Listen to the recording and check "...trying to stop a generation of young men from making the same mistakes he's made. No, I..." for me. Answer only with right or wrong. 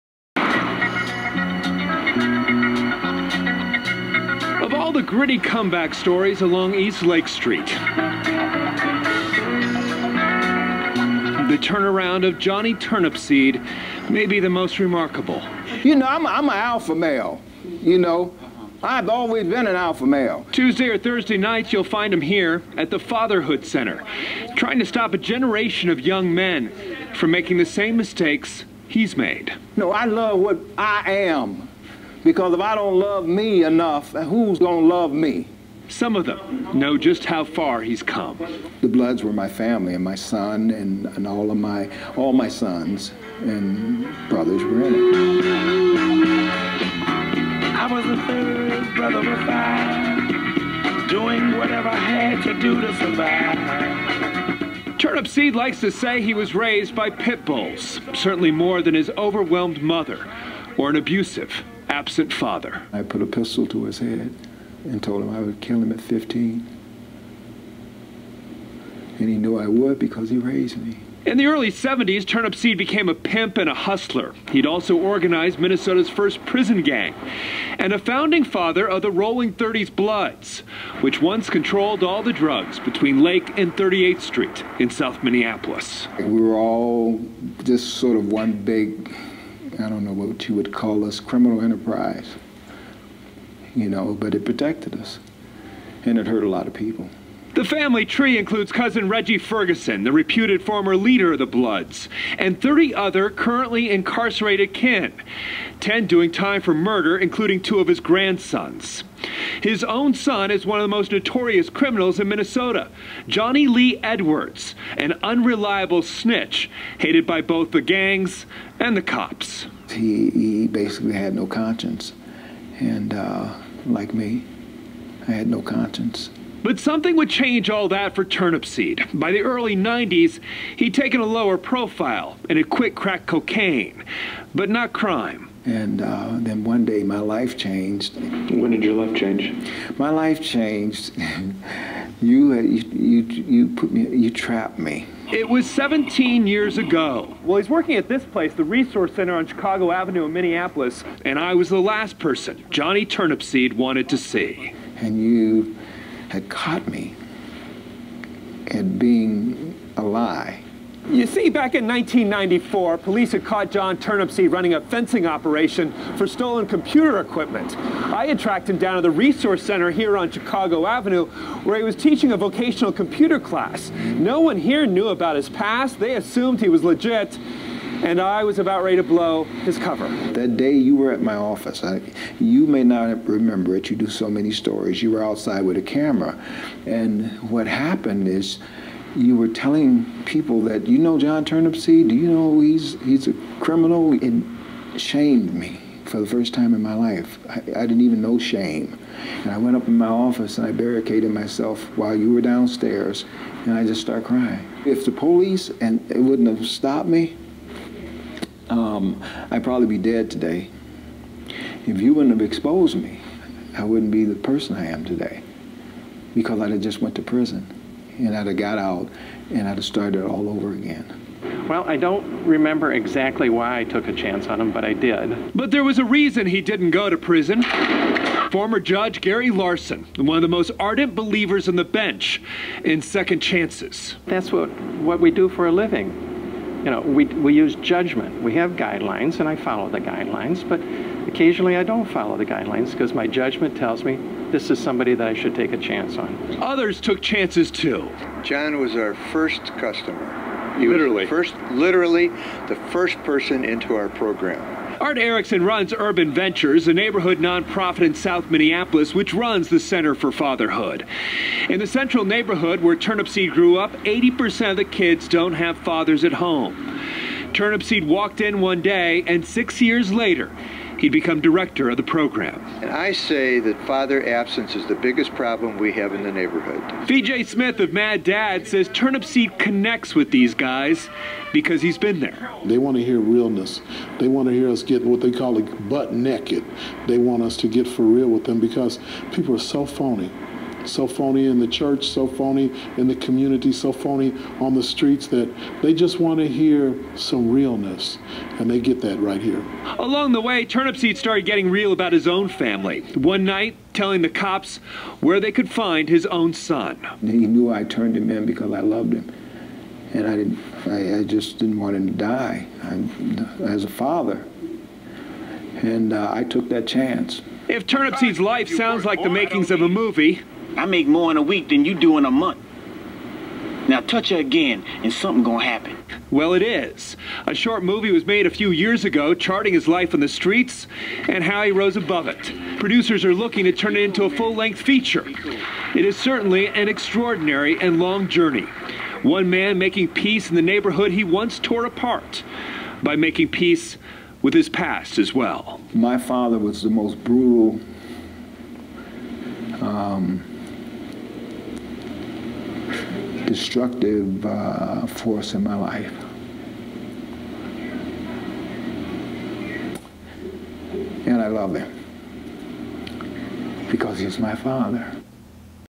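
right.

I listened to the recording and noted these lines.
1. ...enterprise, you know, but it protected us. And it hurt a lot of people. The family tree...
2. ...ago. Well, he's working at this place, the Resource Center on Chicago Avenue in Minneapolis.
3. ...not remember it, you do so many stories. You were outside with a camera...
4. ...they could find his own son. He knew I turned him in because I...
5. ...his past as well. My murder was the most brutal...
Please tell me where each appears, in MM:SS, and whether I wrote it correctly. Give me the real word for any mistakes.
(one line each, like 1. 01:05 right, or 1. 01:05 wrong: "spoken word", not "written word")
1. 01:31 right
2. 02:26 right
3. 03:02 right
4. 05:05 right
5. 05:44 wrong: "father", not "murder".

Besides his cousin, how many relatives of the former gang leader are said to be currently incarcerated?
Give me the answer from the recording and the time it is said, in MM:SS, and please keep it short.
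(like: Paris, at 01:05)
30, at 01:42.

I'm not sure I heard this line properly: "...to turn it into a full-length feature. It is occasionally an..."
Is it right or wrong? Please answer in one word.
wrong.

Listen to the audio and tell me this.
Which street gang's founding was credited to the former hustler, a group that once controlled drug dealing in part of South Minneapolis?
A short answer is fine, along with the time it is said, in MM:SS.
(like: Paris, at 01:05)
Rolling 30s Bloods, at 01:19.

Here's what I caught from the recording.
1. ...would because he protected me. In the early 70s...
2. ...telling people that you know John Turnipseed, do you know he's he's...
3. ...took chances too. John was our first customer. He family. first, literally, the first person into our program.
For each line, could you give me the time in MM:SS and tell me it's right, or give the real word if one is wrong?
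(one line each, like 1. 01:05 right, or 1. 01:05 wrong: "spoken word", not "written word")
1. 01:09 wrong: "raised", not "protected"
2. 03:09 right
3. 04:07 wrong: "literally", not "family".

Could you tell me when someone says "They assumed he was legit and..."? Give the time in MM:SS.
02:55.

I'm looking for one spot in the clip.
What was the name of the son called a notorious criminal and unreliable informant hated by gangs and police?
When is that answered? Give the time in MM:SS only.
01:53.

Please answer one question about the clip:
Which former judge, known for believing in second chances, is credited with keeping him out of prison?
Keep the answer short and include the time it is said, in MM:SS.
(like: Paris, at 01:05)
Gary Larson, at 03:49.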